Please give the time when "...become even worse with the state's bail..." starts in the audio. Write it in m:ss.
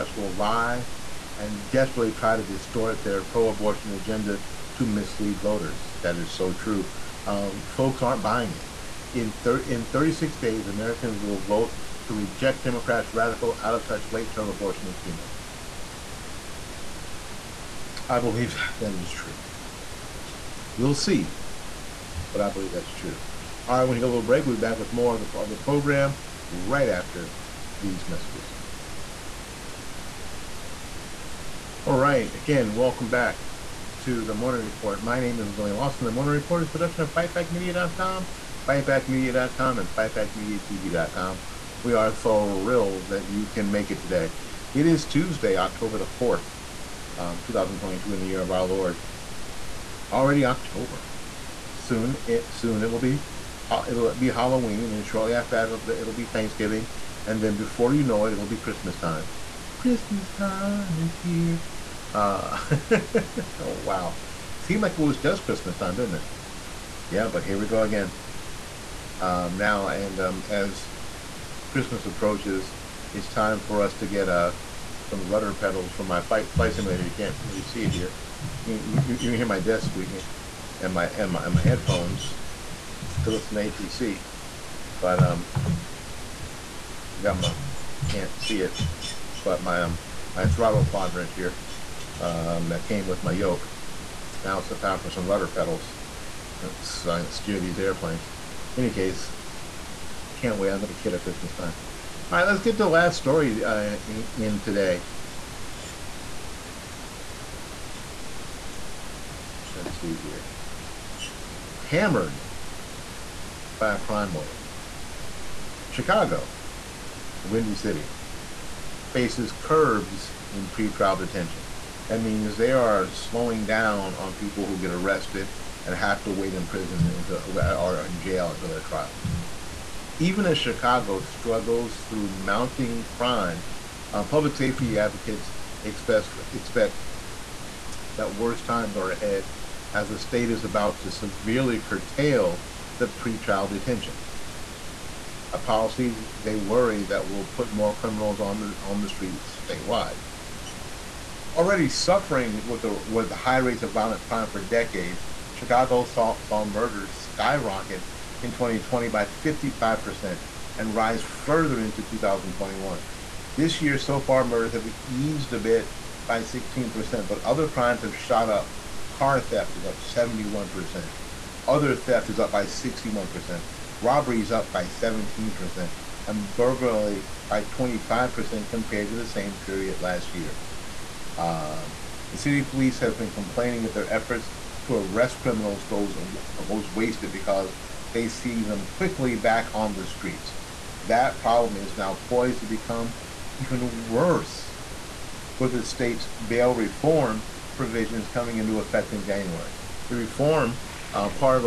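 3:12.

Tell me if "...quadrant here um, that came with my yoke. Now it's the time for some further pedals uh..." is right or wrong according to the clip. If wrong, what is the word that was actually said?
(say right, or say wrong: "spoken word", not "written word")
wrong: "rudder", not "further".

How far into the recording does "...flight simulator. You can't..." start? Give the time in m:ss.
1:16.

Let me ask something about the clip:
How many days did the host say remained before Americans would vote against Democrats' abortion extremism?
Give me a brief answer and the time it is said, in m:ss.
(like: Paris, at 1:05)
36, at 0:09.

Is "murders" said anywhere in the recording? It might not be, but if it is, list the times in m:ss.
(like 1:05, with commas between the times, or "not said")
2:36, 2:44.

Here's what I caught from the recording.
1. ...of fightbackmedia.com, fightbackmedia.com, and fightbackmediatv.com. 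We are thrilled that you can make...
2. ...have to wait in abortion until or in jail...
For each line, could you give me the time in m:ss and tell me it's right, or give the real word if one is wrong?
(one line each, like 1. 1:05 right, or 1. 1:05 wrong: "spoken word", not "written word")
1. 0:37 right
2. 2:05 wrong: "prison", not "abortion".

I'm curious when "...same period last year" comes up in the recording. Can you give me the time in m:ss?
2:59.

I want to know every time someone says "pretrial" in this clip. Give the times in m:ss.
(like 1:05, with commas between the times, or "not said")
2:00, 2:23.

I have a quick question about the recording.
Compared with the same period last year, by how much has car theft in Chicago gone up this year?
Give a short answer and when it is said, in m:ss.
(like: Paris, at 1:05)
71%, at 2:49.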